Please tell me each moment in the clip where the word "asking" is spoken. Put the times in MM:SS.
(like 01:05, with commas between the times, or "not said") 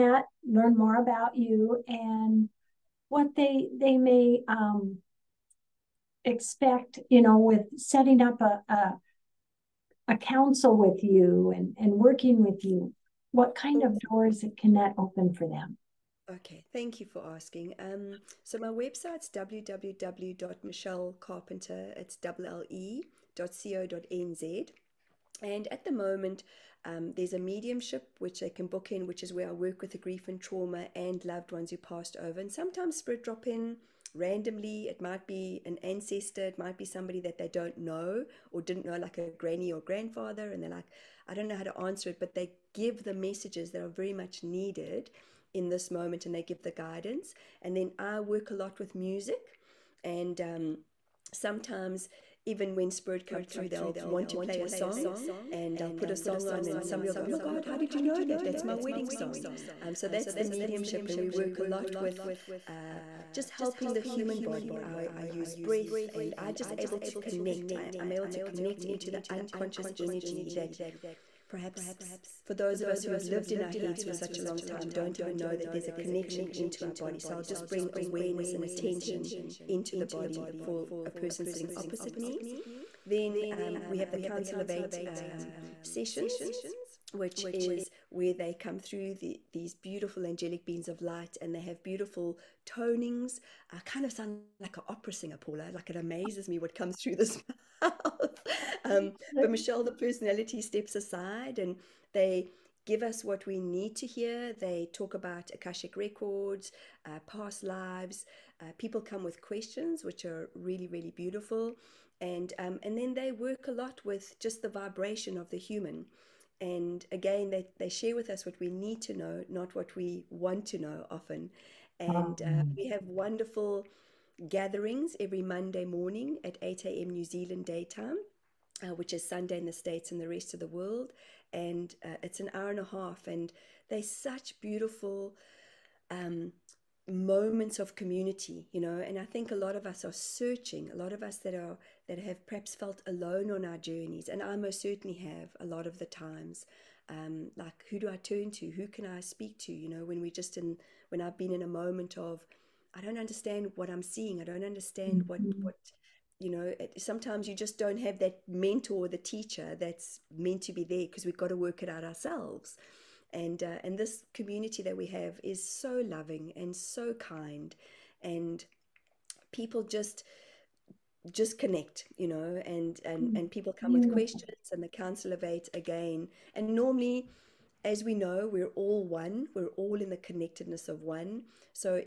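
00:17.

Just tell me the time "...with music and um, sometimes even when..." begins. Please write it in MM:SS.
00:48.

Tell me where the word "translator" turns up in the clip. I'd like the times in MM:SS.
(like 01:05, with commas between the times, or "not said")
not said.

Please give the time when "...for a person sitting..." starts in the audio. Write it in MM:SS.
01:20.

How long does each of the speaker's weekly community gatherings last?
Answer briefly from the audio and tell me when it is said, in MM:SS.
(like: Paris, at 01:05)
an hour and a half, at 02:12.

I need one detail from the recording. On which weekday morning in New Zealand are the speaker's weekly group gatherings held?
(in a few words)
Monday.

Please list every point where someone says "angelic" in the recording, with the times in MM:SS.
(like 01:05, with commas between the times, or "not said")
01:30.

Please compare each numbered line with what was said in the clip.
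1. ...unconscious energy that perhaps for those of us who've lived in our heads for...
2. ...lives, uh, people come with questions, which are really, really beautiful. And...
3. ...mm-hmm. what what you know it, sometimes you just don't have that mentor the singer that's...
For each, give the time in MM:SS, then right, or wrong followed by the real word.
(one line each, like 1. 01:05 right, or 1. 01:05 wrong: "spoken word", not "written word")
1. 01:09 right
2. 01:47 right
3. 02:35 wrong: "teacher", not "singer".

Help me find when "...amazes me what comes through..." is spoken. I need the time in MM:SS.
01:35.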